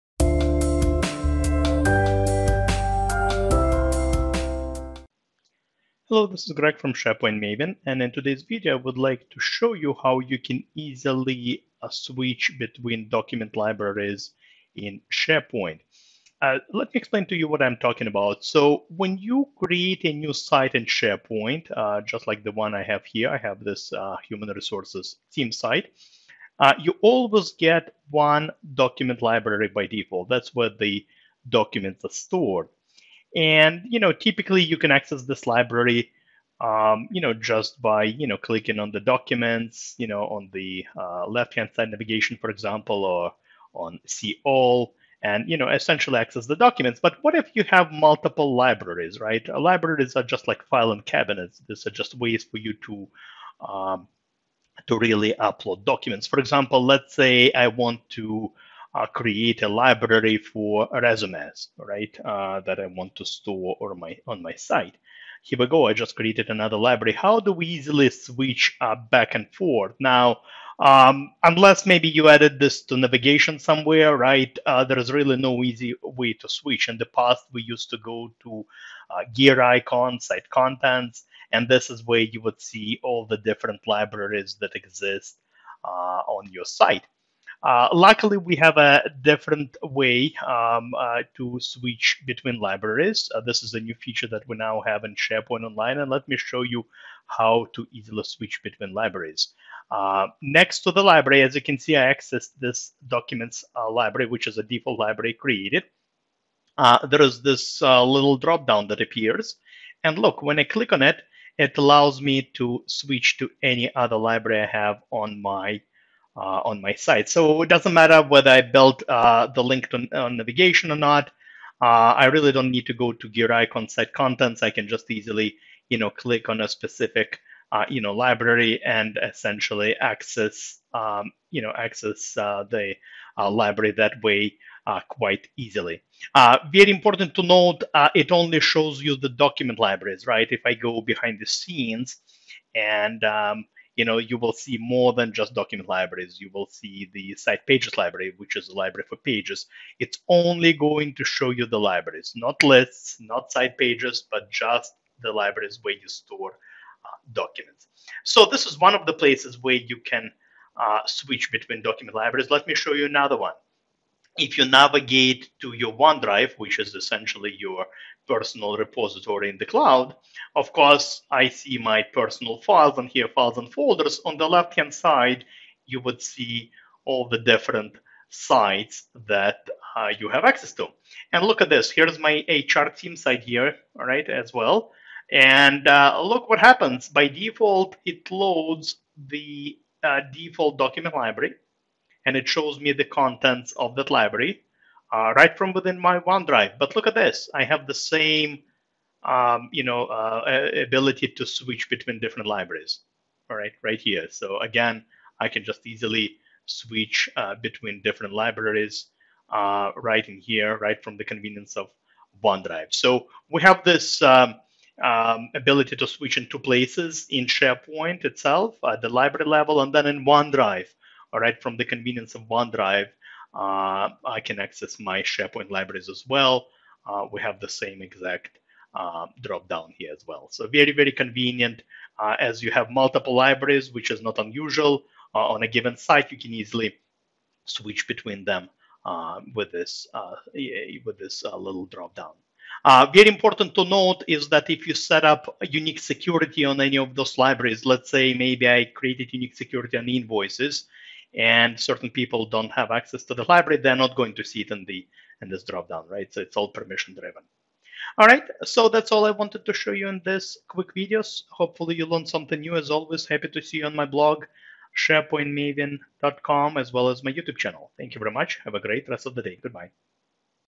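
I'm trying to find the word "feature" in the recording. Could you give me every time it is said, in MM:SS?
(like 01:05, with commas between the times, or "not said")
01:33.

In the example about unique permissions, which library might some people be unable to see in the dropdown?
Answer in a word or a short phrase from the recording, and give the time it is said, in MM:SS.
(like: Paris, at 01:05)
Invoices, at 04:10.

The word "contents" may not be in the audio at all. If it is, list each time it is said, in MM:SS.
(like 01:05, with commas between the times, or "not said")
01:20, 02:04, 03:13.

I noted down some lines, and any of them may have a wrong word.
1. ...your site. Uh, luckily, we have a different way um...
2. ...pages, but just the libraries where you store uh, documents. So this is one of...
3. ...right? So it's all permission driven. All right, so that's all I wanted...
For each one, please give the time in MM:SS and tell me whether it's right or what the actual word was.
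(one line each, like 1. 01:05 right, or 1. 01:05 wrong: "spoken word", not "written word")
1. 01:26 right
2. 02:33 right
3. 04:16 right.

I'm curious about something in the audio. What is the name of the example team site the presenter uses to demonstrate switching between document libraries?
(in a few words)
Human resources.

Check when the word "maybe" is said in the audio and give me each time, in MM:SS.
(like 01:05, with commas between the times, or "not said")
01:11, 04:08.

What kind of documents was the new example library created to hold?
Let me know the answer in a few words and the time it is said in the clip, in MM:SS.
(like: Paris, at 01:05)
Resumes, at 01:00.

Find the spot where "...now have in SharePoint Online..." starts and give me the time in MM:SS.
01:34.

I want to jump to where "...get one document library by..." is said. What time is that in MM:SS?
00:27.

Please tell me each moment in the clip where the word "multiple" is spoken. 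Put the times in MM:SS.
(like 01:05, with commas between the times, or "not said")
00:47, 03:52.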